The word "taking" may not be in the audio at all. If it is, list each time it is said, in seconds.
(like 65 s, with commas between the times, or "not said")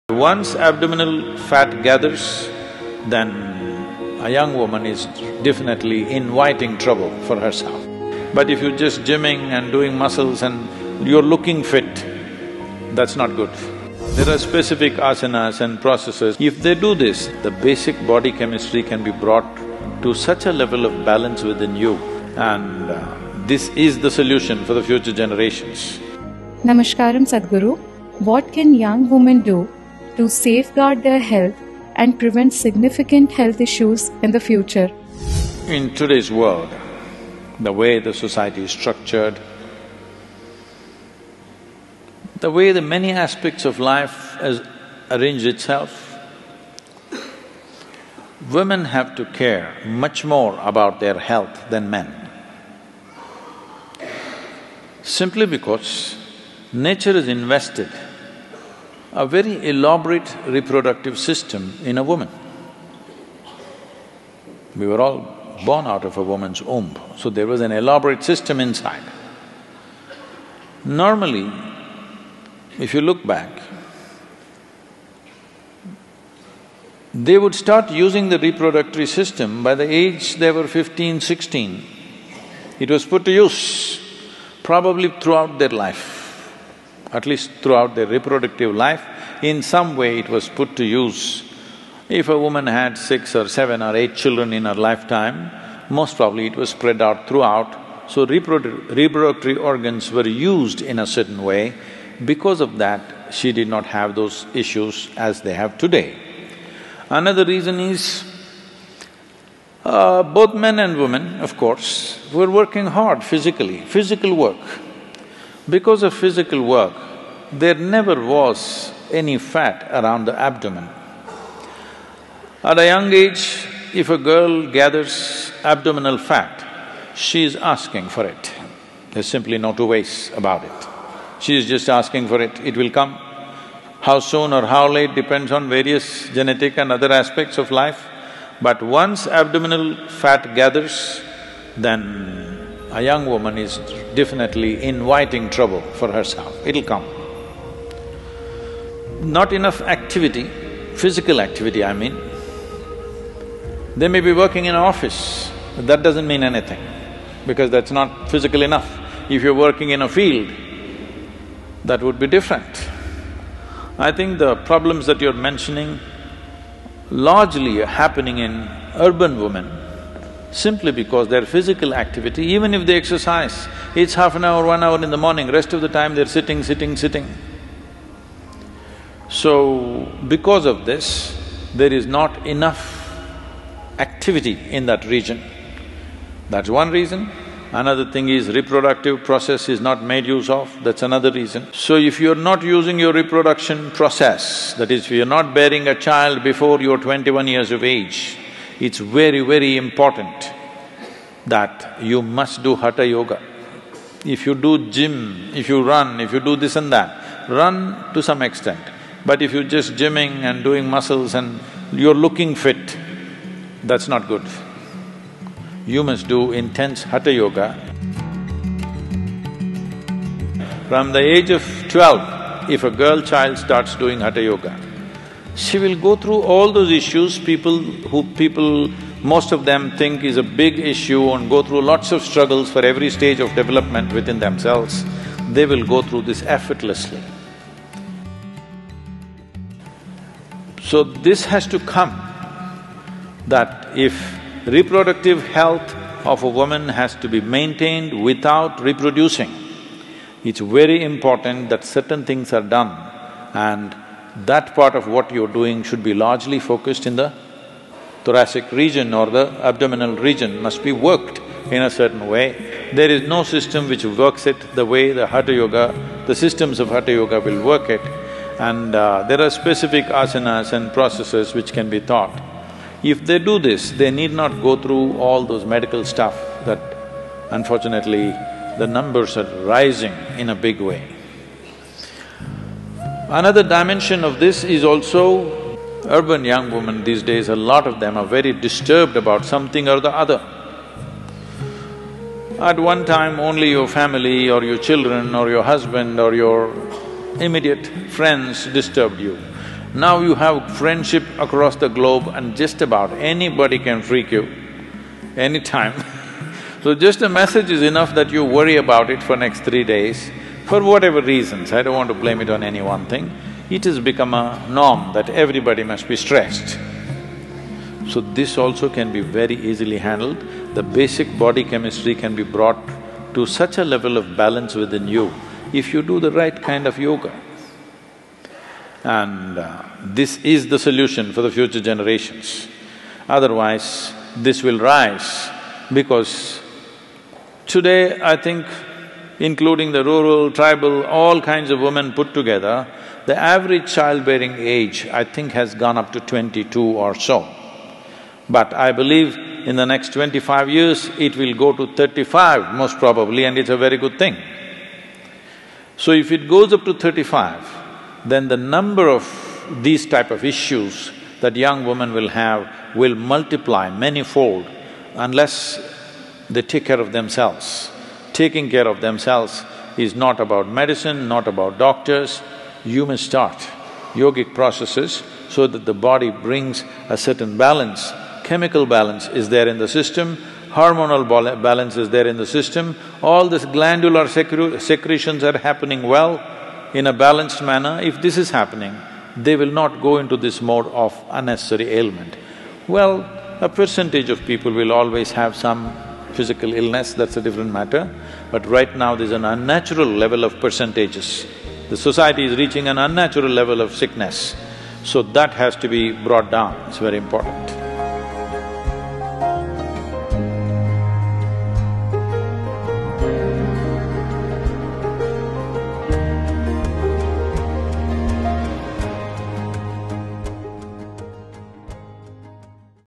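368 s.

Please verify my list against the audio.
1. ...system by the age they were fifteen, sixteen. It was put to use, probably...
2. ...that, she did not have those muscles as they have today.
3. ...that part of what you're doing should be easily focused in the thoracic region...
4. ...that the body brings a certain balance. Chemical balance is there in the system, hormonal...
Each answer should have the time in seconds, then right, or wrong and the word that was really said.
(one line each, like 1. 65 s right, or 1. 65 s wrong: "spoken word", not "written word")
1. 79 s right
2. 102 s wrong: "issues", not "muscles"
3. 254 s wrong: "largely", not "easily"
4. 375 s right.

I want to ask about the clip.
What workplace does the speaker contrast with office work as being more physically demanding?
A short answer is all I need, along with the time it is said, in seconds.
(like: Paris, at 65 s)
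a field, at 160 s.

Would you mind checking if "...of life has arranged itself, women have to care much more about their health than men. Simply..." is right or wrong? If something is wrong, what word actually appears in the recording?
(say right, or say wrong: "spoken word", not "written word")
right.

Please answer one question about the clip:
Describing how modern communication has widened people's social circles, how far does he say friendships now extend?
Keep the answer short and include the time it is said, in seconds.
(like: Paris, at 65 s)
across the globe, at 301 s.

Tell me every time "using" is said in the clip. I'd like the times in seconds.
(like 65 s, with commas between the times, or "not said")
77 s, 192 s.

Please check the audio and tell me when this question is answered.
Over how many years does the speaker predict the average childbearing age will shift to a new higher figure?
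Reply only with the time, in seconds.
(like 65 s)
350 s.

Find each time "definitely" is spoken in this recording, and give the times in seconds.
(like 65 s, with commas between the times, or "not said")
5 s, 144 s.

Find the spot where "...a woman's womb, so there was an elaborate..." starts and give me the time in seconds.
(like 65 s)
66 s.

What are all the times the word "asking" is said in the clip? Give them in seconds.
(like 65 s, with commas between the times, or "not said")
127 s, 131 s.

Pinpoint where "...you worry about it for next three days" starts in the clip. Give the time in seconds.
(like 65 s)
308 s.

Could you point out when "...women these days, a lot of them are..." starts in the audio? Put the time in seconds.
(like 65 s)
286 s.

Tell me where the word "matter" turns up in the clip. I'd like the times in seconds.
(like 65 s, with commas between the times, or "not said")
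397 s.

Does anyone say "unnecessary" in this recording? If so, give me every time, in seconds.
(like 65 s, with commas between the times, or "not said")
391 s.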